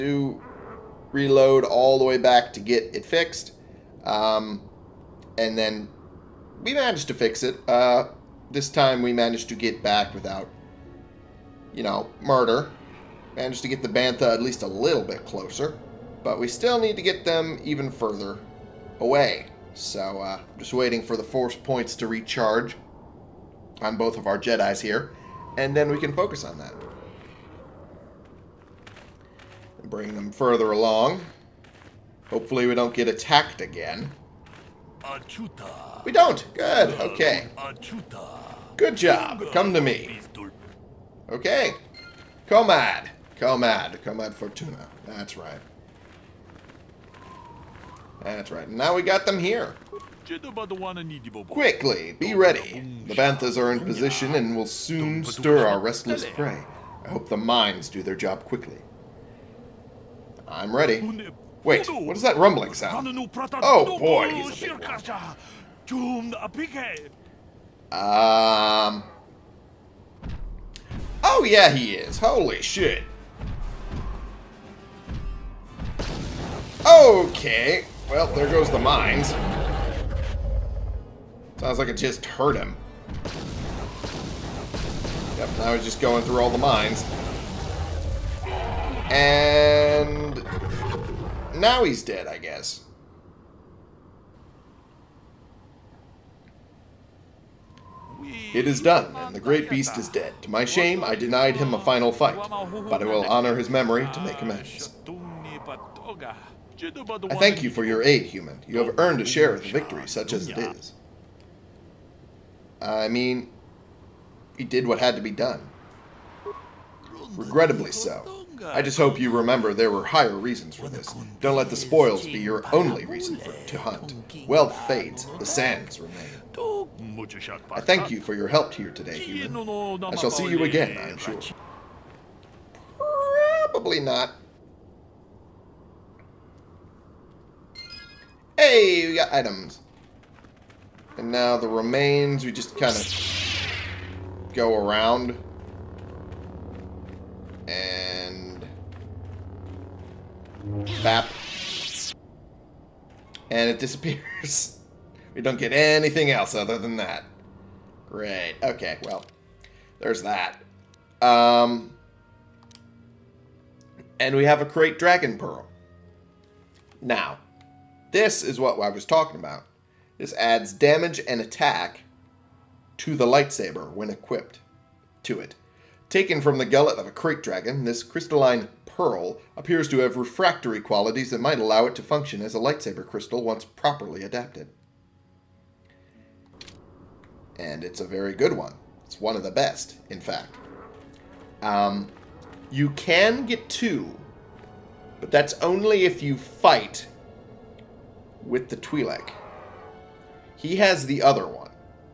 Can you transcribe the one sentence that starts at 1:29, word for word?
And now he's dead, I guess.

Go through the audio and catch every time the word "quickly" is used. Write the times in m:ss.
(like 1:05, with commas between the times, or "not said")
0:51, 0:58.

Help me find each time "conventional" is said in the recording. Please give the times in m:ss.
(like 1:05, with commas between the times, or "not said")
not said.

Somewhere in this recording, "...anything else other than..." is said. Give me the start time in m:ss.
2:35.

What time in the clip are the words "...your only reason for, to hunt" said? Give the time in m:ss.
2:02.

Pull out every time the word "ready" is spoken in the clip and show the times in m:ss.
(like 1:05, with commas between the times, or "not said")
0:52, 1:00.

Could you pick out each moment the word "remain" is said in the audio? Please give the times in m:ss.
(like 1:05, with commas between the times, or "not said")
2:05, 2:21.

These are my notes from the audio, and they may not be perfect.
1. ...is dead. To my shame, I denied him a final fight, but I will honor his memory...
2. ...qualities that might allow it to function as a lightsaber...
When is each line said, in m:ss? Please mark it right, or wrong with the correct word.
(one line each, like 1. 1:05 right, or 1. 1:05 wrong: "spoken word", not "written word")
1. 1:39 right
2. 3:00 right.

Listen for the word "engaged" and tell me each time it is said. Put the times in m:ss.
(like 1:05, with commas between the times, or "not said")
not said.